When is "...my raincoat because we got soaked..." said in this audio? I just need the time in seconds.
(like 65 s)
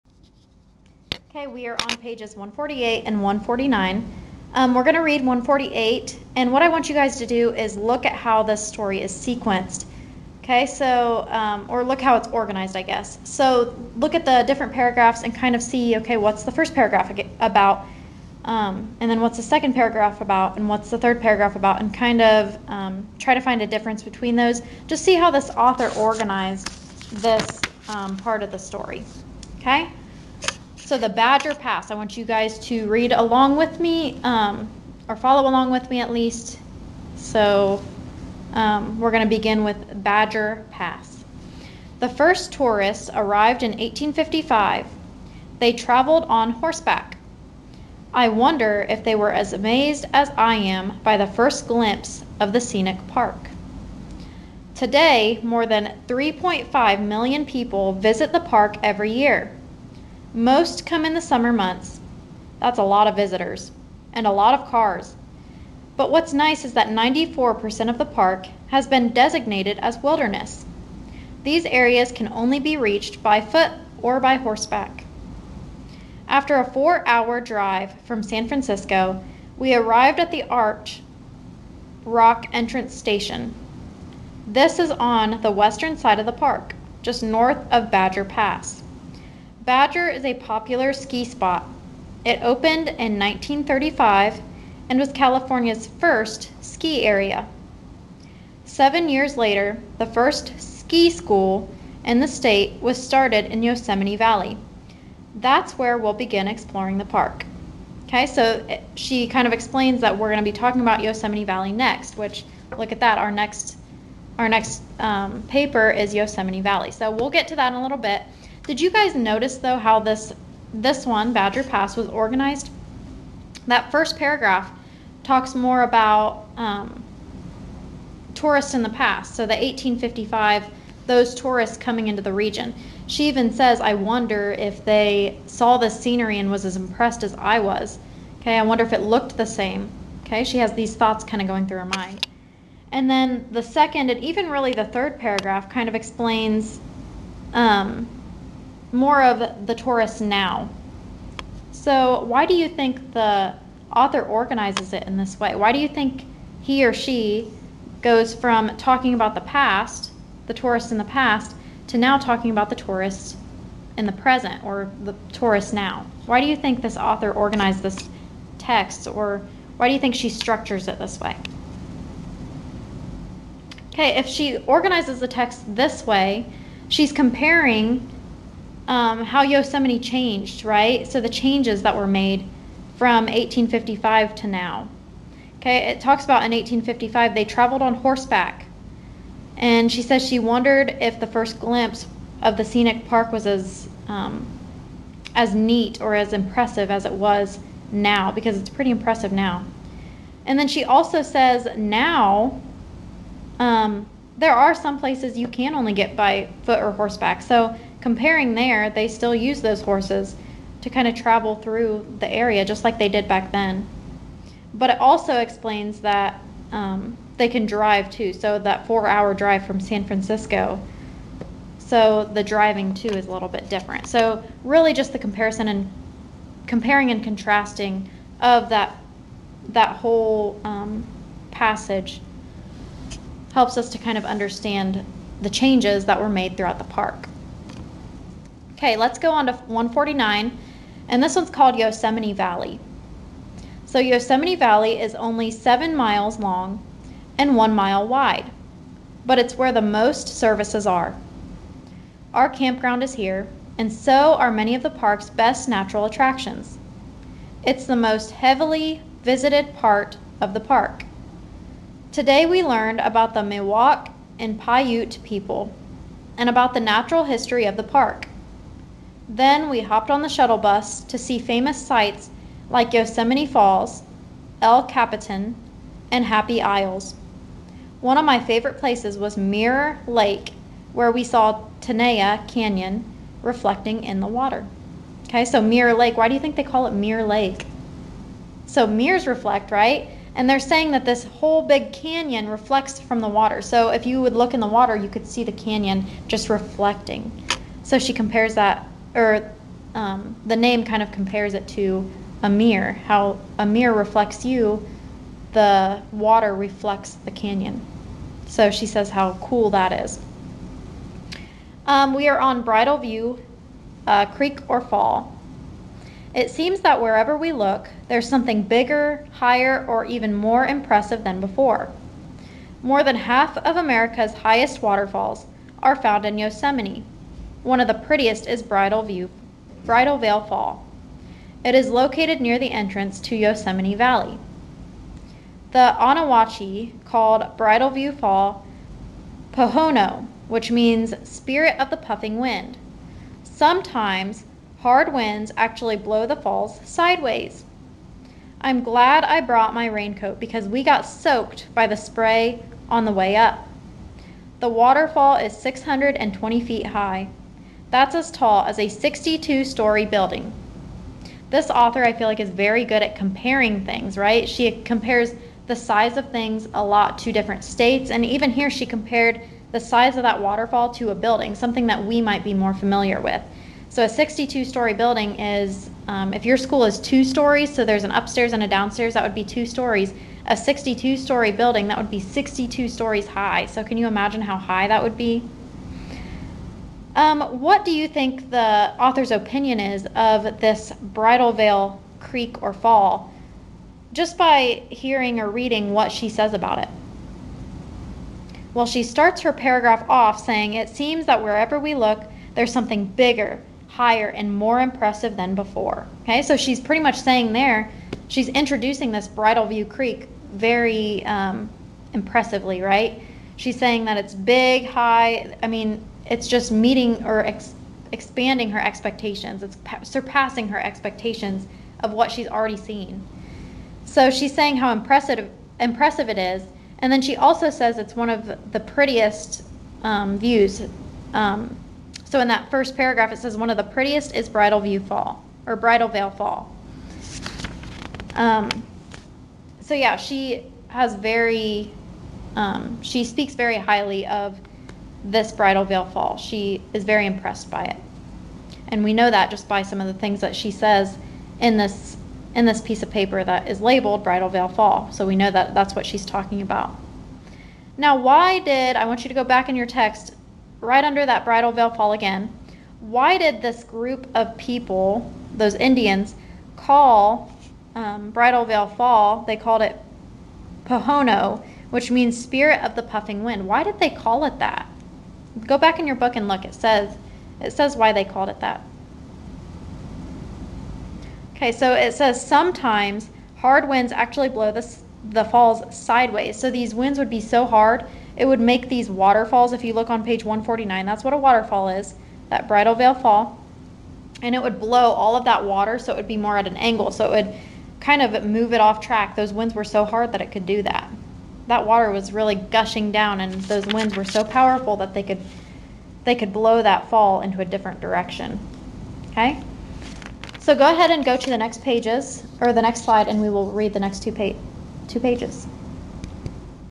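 349 s.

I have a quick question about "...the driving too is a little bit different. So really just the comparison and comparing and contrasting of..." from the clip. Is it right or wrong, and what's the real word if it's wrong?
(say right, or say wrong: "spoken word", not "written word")
right.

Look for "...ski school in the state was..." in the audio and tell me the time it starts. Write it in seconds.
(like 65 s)
100 s.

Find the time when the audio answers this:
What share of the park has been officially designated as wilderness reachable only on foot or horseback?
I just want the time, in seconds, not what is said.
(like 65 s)
66 s.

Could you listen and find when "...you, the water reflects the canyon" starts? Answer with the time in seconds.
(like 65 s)
304 s.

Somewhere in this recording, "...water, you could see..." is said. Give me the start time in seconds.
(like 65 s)
294 s.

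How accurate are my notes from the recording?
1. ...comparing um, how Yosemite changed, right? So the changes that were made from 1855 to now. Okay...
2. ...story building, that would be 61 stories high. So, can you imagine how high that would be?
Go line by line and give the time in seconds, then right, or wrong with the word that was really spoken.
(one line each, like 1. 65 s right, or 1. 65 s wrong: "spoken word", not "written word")
1. 177 s right
2. 381 s wrong: "62", not "61".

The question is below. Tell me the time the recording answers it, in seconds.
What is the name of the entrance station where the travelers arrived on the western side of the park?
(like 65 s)
80 s.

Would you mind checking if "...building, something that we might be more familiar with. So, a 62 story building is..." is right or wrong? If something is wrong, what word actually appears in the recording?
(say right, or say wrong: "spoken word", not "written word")
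right.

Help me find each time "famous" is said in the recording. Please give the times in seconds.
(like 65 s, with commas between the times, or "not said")
271 s.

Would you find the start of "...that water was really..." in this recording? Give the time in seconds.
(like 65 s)
501 s.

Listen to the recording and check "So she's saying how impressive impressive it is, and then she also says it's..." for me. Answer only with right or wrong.
right.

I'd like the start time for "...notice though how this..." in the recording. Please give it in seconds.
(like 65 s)
119 s.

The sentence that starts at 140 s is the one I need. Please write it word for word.
Okay, she has these thoughts kind of going through her mind.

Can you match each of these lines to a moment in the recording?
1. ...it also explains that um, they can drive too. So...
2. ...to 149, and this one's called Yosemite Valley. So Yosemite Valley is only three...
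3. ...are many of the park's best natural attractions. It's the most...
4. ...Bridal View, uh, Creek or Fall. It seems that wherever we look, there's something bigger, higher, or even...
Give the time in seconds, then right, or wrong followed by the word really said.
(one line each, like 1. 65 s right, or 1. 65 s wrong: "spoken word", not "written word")
1. 214 s right
2. 239 s wrong: "seven", not "three"
3. 254 s right
4. 312 s right.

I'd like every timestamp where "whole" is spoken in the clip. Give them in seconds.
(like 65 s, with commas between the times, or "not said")
229 s, 291 s.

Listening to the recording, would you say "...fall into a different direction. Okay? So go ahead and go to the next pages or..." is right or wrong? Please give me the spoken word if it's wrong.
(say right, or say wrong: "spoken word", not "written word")
right.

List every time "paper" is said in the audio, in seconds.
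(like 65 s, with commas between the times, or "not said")
115 s, 453 s.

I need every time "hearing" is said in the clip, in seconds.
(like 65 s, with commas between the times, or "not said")
394 s.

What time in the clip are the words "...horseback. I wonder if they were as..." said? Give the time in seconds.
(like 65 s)
46 s.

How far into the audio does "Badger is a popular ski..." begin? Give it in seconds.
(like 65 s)
89 s.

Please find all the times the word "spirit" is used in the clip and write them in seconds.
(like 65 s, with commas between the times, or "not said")
341 s, 472 s.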